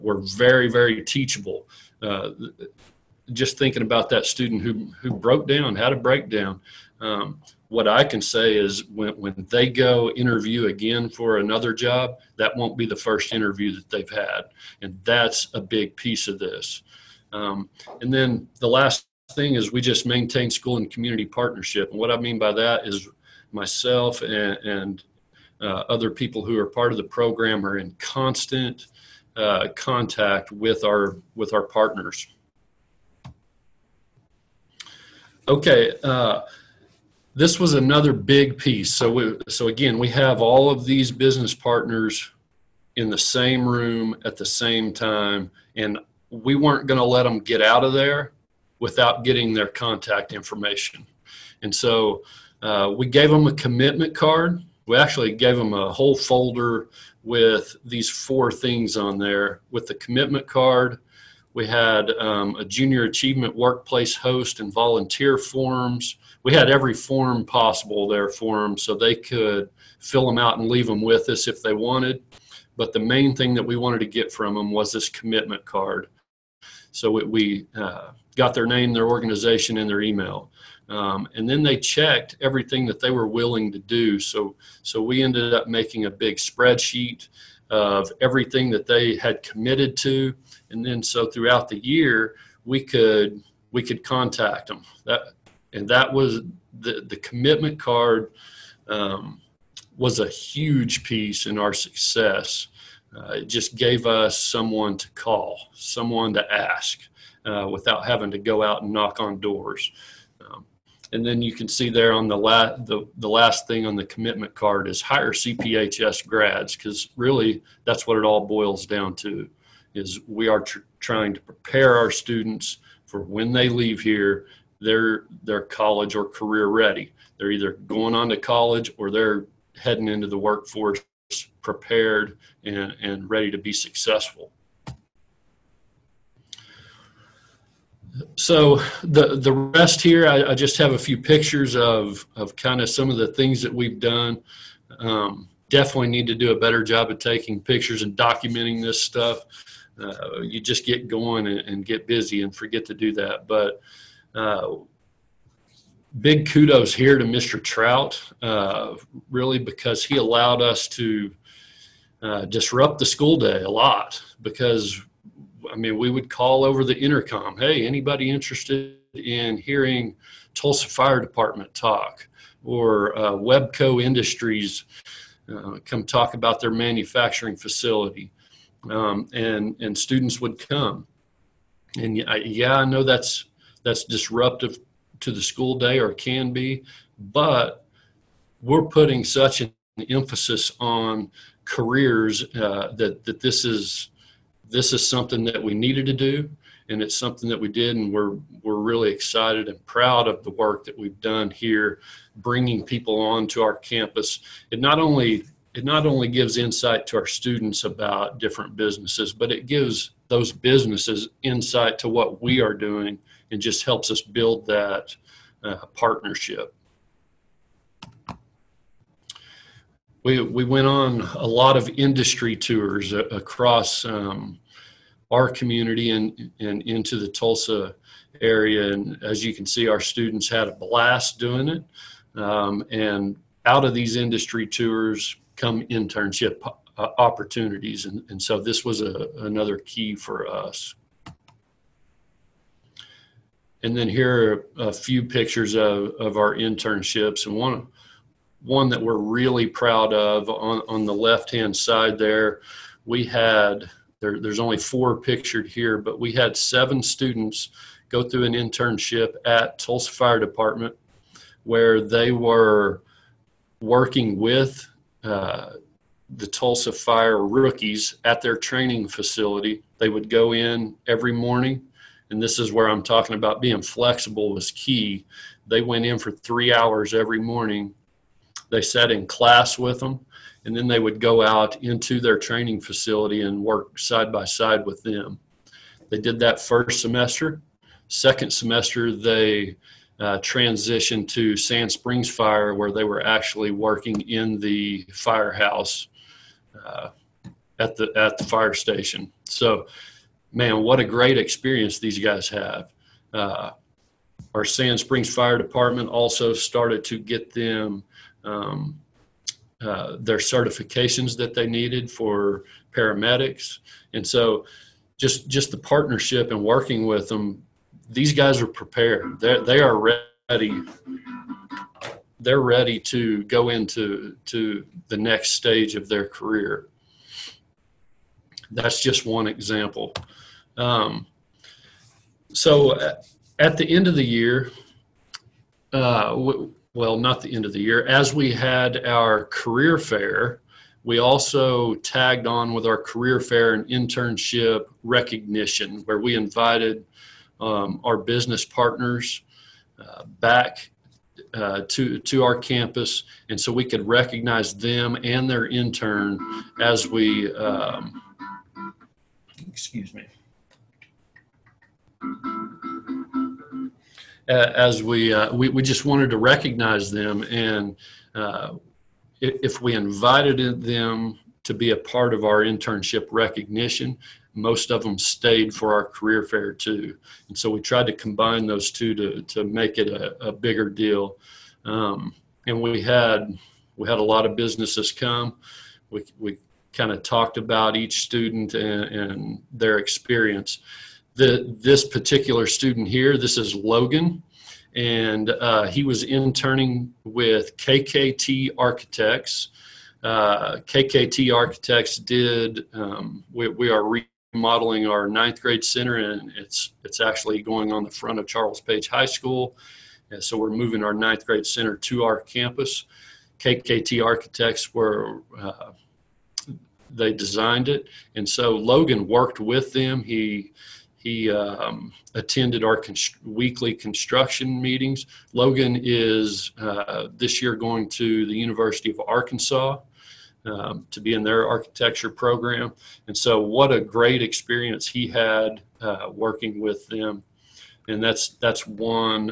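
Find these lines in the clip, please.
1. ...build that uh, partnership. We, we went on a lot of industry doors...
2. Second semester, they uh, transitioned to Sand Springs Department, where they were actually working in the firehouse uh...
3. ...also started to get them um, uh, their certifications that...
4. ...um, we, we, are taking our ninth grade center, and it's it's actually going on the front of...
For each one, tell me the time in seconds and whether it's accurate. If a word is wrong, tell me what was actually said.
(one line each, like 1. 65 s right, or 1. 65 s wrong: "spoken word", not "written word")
1. 214 s wrong: "tours", not "doors"
2. 288 s wrong: "Fire", not "Department"
3. 306 s right
4. 402 s wrong: "remodeling", not "taking".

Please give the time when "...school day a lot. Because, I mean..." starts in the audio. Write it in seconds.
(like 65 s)
163 s.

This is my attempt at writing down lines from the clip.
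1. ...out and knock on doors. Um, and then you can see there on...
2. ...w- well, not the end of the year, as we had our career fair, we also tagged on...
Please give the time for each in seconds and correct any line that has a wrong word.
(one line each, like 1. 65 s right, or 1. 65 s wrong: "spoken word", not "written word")
1. 108 s right
2. 336 s right.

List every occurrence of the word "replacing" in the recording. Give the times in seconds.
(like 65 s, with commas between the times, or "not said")
not said.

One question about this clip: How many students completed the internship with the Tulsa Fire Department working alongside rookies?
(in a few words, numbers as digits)
7.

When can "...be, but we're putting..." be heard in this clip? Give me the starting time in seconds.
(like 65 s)
186 s.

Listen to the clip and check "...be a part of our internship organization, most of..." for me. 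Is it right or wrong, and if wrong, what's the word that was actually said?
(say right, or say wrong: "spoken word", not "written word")
wrong: "recognition", not "organization".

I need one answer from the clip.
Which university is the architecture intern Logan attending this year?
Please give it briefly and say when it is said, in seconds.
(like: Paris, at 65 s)
University of Arkansas, at 428 s.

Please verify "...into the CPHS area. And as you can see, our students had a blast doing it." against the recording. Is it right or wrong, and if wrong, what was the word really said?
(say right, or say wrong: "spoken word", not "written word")
wrong: "Tulsa", not "CPHS".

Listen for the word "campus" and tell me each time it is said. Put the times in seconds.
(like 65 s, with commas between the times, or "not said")
203 s, 352 s, 412 s.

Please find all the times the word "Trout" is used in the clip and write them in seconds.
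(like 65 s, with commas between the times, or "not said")
157 s.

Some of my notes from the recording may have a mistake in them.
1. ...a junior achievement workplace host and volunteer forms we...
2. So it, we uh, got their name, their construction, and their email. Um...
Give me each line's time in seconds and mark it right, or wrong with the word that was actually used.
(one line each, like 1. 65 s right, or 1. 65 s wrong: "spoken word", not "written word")
1. 62 s right
2. 76 s wrong: "organization", not "construction".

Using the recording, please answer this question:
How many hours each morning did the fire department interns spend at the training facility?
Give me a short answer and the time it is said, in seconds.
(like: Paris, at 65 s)
3, at 276 s.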